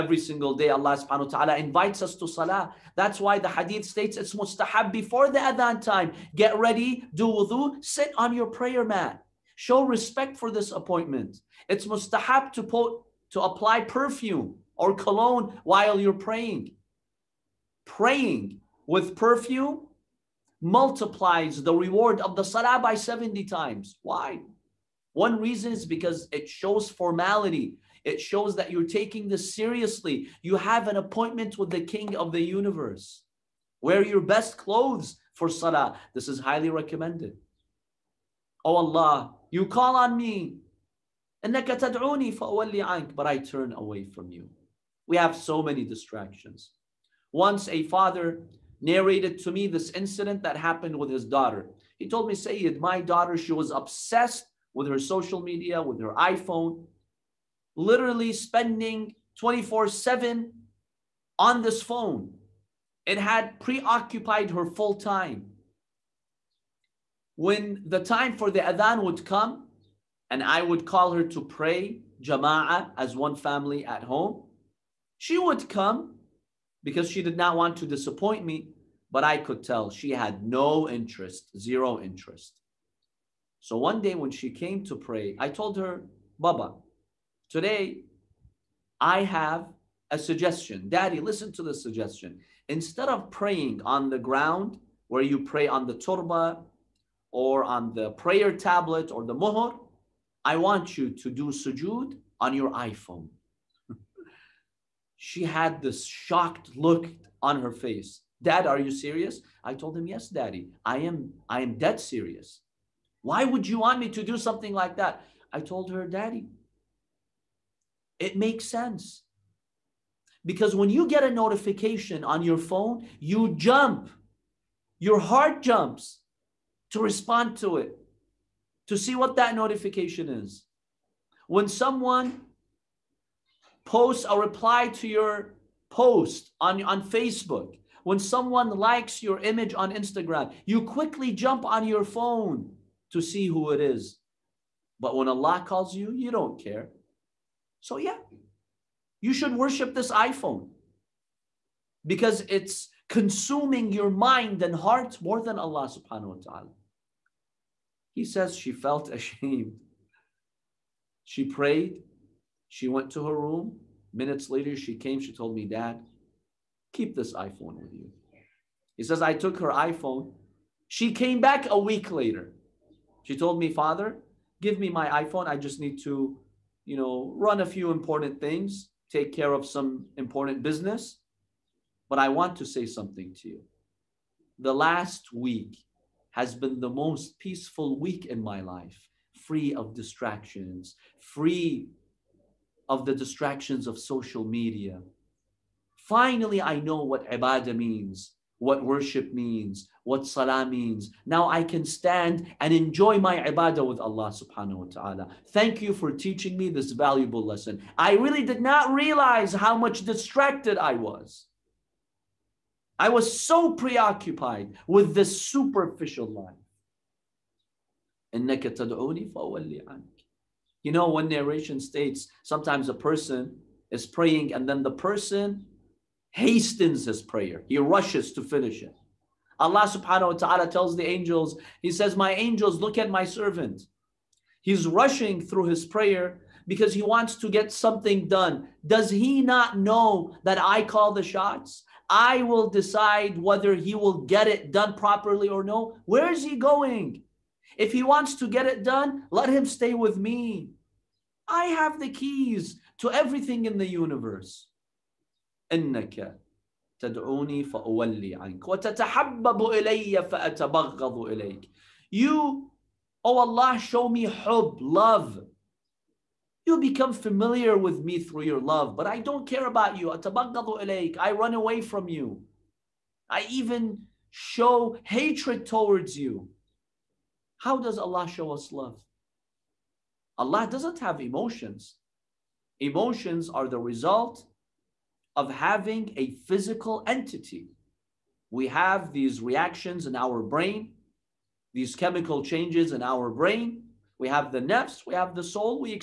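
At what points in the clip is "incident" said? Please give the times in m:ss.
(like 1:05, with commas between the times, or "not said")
0:49.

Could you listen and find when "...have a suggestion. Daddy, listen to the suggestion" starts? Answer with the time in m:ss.
1:29.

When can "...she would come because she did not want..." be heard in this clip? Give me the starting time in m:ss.
1:15.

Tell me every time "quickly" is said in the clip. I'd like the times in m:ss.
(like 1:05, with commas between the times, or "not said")
2:20.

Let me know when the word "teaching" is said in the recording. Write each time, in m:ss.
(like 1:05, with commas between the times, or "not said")
3:26.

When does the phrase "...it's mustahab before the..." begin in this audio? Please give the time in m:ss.
0:04.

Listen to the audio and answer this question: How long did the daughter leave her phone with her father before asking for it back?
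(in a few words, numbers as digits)
A week.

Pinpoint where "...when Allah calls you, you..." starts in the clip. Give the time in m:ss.
2:25.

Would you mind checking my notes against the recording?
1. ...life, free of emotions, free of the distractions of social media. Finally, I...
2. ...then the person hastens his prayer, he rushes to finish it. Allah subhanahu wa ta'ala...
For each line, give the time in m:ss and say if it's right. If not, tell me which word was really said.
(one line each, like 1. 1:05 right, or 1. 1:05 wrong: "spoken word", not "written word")
1. 3:08 wrong: "distractions", not "emotions"
2. 3:44 right.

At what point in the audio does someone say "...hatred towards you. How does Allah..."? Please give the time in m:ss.
4:35.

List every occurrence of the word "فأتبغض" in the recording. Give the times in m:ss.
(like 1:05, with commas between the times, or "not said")
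4:20.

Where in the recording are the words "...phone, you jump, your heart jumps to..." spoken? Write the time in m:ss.
2:02.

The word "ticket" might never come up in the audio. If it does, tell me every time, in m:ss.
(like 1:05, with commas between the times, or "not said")
not said.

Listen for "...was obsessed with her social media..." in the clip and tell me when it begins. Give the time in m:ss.
0:53.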